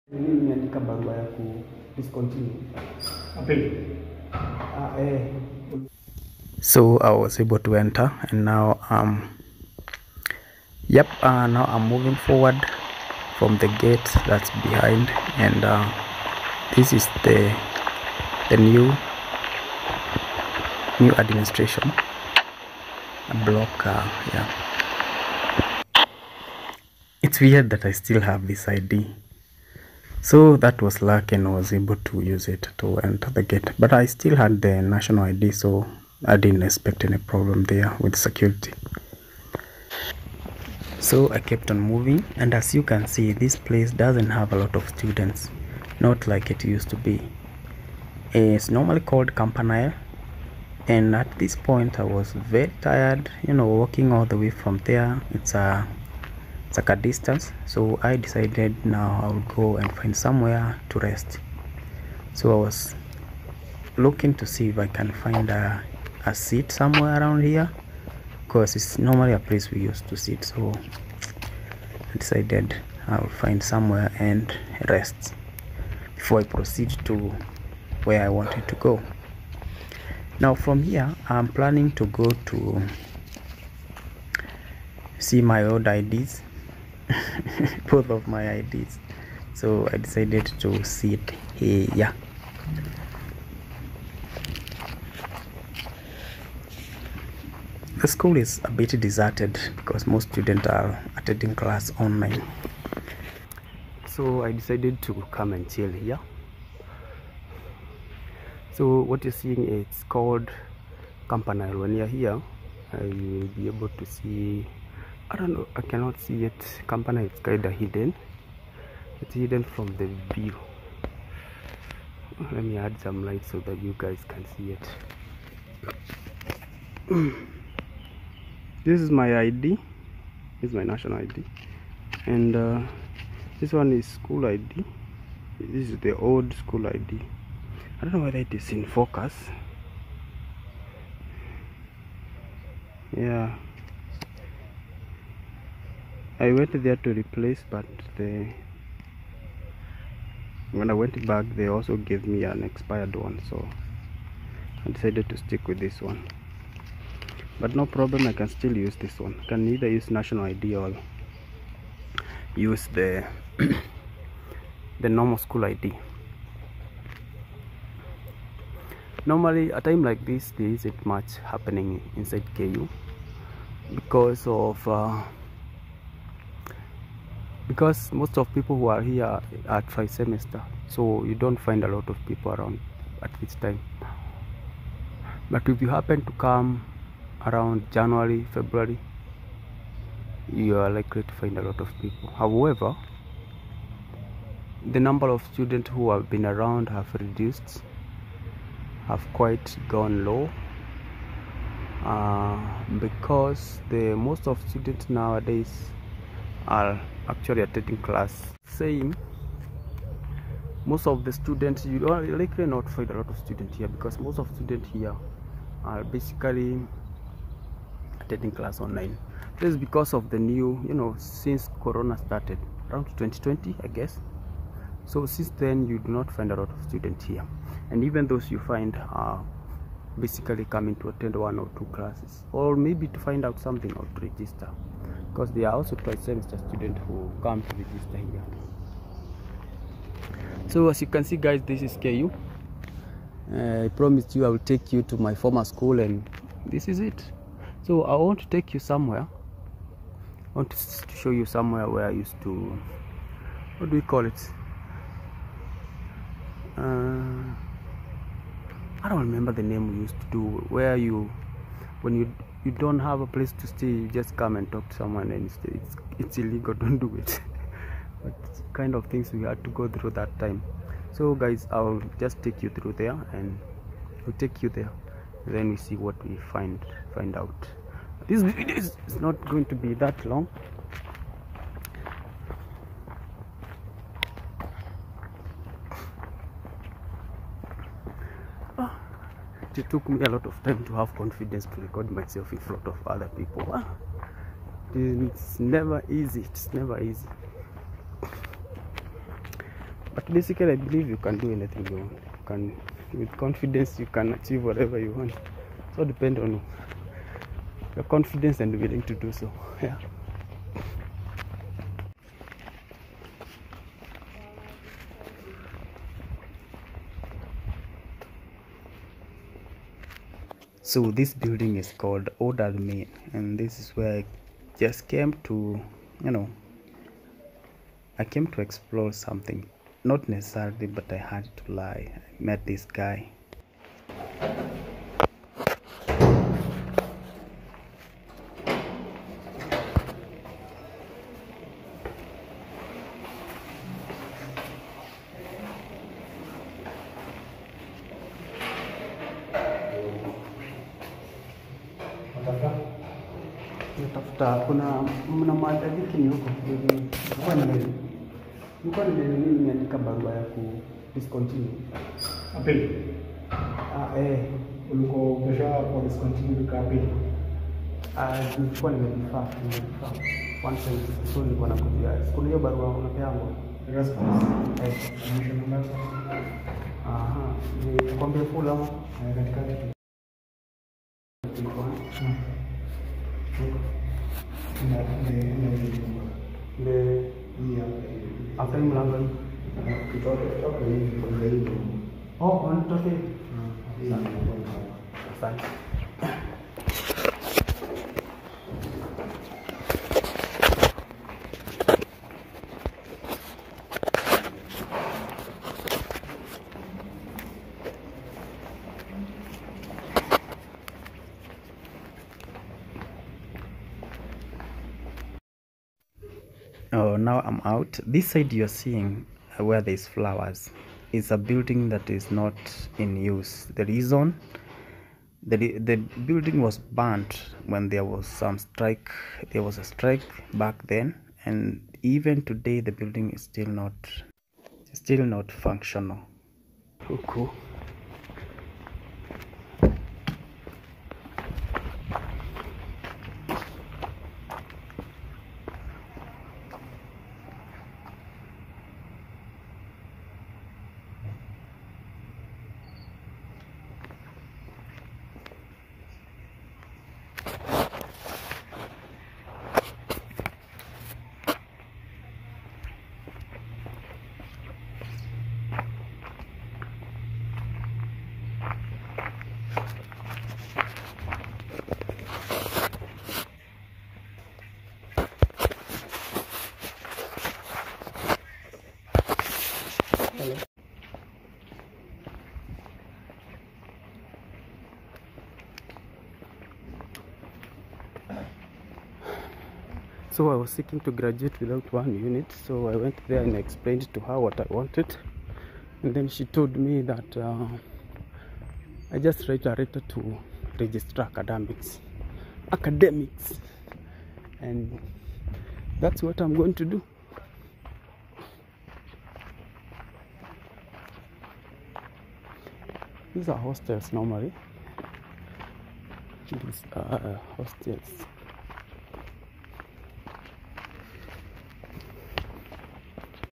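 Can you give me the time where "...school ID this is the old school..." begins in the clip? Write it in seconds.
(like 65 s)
134 s.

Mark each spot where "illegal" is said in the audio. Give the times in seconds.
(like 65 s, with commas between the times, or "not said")
266 s.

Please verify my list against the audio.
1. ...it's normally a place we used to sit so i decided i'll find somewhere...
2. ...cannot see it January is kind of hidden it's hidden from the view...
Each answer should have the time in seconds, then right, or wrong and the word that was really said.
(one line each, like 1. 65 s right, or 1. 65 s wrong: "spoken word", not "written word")
1. 68 s right
2. 115 s wrong: "Campana", not "January".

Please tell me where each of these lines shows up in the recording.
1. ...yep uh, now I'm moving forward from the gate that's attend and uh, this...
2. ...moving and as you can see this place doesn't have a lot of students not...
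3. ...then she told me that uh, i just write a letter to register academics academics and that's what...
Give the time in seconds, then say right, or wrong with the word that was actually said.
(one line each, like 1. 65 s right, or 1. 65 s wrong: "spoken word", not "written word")
1. 10 s wrong: "behind", not "attend"
2. 41 s right
3. 496 s right.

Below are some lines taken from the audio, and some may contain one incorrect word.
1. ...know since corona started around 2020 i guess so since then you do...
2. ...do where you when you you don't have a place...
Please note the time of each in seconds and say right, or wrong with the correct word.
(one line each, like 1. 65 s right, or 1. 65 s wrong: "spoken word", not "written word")
1. 220 s right
2. 260 s right.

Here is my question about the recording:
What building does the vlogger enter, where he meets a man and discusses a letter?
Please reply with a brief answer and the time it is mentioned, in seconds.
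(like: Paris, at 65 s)
Odal Main, at 322 s.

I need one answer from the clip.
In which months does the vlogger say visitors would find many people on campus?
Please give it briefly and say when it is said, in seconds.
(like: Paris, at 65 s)
January February, at 187 s.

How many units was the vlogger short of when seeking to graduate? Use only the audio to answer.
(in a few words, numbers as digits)
1.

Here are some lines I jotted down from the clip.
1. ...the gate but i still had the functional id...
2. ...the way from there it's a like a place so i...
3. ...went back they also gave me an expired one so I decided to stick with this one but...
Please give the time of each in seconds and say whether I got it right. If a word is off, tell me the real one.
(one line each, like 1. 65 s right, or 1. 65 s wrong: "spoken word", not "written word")
1. 33 s wrong: "national", not "functional"
2. 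54 s wrong: "distance", not "place"
3. 150 s right.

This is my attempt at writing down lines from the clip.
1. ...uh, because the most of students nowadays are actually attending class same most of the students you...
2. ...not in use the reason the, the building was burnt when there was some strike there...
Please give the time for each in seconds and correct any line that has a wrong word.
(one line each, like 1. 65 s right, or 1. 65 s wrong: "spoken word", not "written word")
1. 202 s right
2. 422 s right.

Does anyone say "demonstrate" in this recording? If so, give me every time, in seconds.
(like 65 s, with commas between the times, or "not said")
not said.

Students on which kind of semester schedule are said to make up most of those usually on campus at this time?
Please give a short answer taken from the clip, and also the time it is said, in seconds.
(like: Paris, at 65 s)
tri-semester, at 179 s.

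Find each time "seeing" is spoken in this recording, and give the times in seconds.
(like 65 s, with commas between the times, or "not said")
109 s, 418 s.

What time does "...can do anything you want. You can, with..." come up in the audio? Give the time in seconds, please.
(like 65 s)
301 s.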